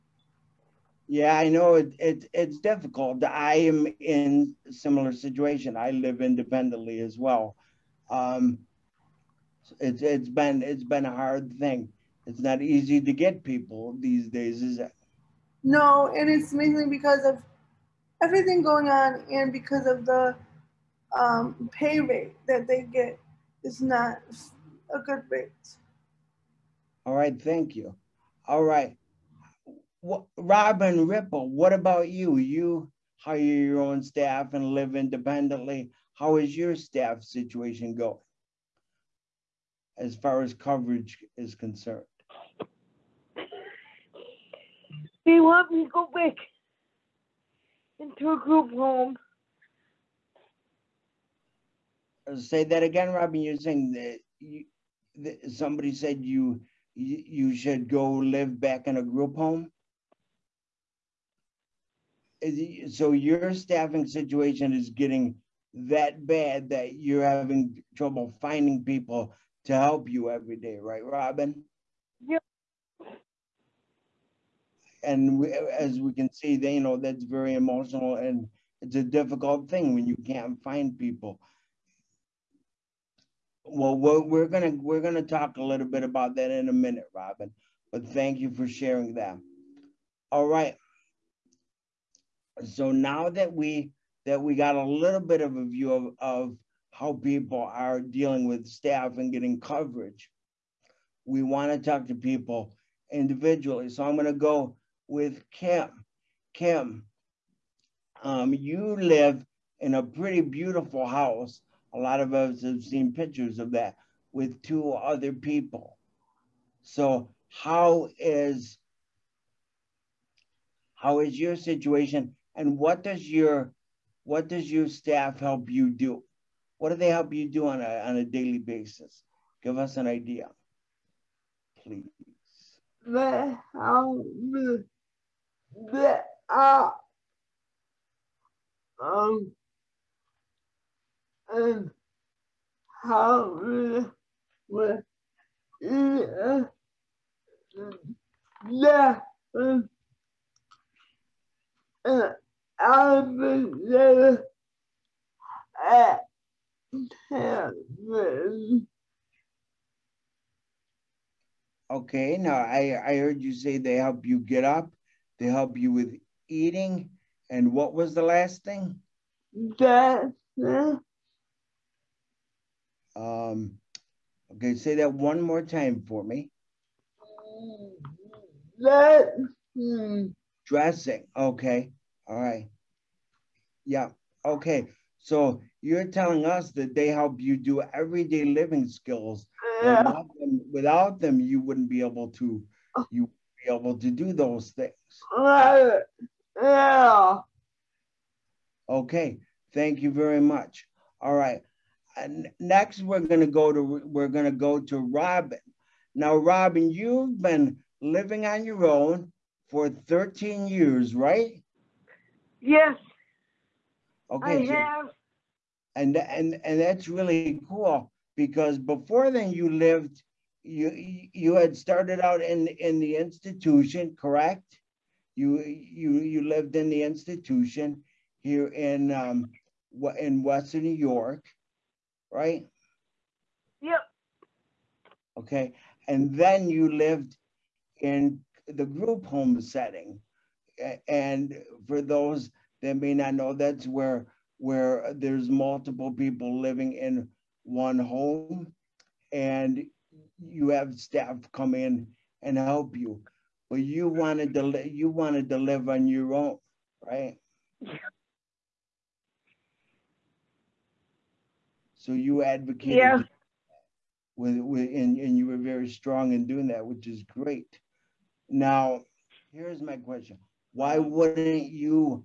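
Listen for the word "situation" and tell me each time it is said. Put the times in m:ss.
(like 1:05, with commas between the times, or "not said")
0:05, 0:37, 1:04, 2:01.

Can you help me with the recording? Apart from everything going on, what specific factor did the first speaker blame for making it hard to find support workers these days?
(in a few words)
pay rate.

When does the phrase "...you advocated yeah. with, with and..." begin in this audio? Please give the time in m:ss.
4:22.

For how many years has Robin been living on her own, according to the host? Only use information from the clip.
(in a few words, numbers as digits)
13 years.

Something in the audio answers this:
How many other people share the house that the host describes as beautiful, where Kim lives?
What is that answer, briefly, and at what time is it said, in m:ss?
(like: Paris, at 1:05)
2, at 1:54.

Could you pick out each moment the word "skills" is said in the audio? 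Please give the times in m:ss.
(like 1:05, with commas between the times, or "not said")
3:08.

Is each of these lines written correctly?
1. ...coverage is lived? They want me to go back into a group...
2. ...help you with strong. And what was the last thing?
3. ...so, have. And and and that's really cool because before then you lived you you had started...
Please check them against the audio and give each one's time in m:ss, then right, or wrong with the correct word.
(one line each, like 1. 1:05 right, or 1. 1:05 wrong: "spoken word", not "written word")
1. 0:40 wrong: "concerned", not "lived"
2. 2:45 wrong: "eating", not "strong"
3. 3:34 right.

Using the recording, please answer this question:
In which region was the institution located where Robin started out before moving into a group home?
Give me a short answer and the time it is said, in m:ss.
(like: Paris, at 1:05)
Western New York, at 3:50.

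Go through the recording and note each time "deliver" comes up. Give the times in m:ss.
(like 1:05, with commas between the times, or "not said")
4:14.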